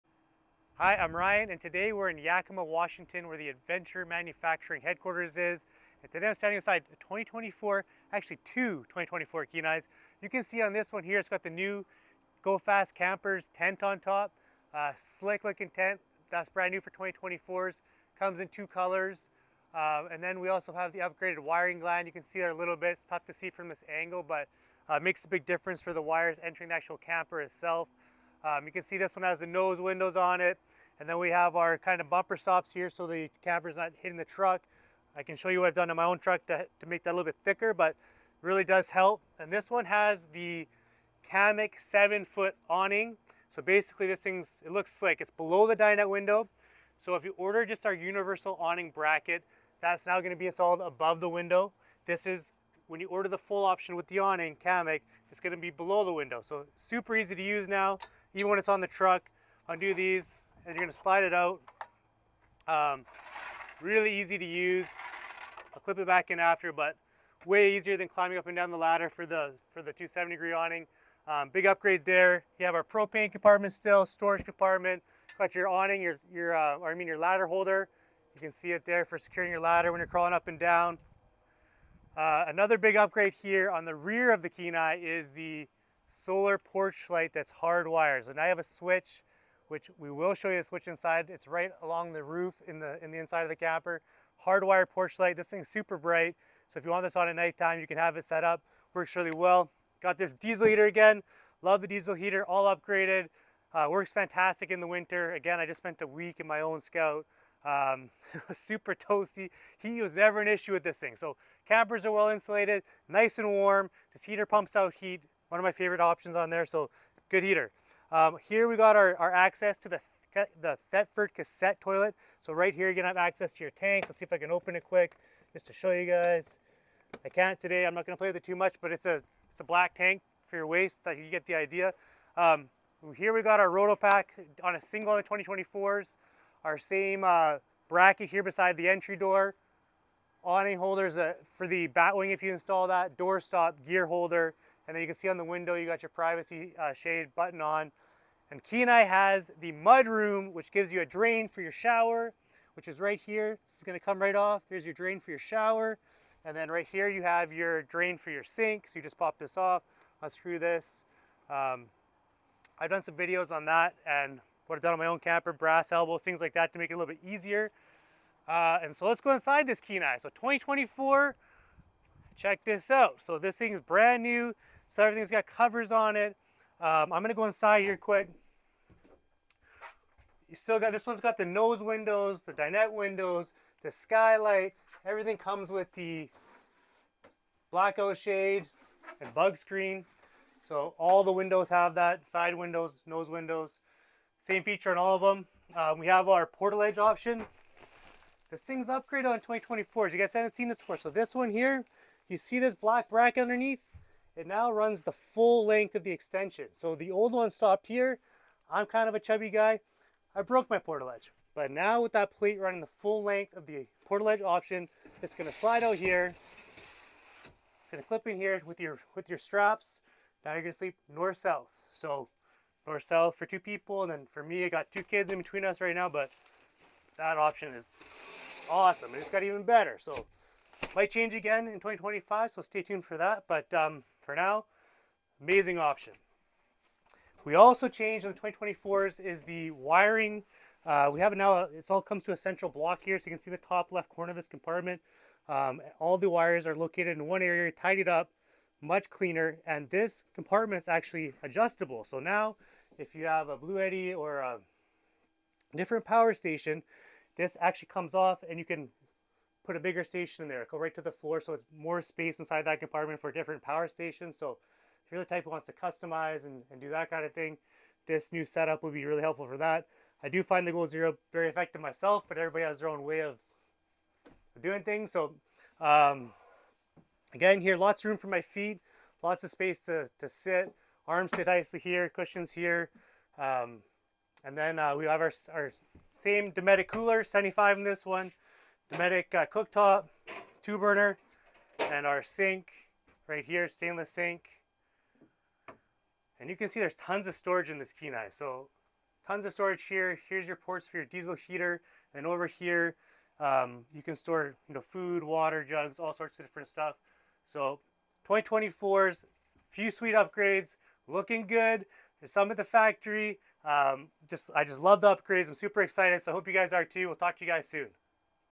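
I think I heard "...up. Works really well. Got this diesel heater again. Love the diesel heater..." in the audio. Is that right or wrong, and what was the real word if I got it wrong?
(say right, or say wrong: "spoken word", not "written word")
right.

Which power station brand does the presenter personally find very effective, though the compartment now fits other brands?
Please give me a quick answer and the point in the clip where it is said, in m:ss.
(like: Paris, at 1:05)
Goal Zero, at 4:30.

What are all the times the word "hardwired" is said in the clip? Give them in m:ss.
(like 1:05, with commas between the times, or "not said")
1:27, 1:34.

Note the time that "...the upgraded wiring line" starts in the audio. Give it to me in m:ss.
0:20.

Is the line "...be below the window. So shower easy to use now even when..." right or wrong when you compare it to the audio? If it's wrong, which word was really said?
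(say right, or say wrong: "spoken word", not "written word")
wrong: "super", not "shower".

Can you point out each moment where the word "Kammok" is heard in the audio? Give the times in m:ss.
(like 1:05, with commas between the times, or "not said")
0:41, 0:54.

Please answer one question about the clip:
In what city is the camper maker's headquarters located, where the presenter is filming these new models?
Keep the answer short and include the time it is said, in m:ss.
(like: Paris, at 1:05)
Yakima, Washington, at 0:02.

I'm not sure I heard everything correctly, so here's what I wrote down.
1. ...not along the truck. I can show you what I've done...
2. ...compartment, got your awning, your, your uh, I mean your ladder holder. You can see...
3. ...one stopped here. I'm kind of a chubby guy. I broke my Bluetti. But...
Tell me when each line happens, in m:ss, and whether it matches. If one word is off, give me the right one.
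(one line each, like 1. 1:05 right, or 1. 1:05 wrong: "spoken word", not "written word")
1. 0:33 wrong: "hitting", not "along"
2. 1:14 right
3. 3:27 wrong: "Portaledge", not "Bluetti".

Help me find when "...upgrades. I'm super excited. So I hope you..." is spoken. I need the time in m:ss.
5:15.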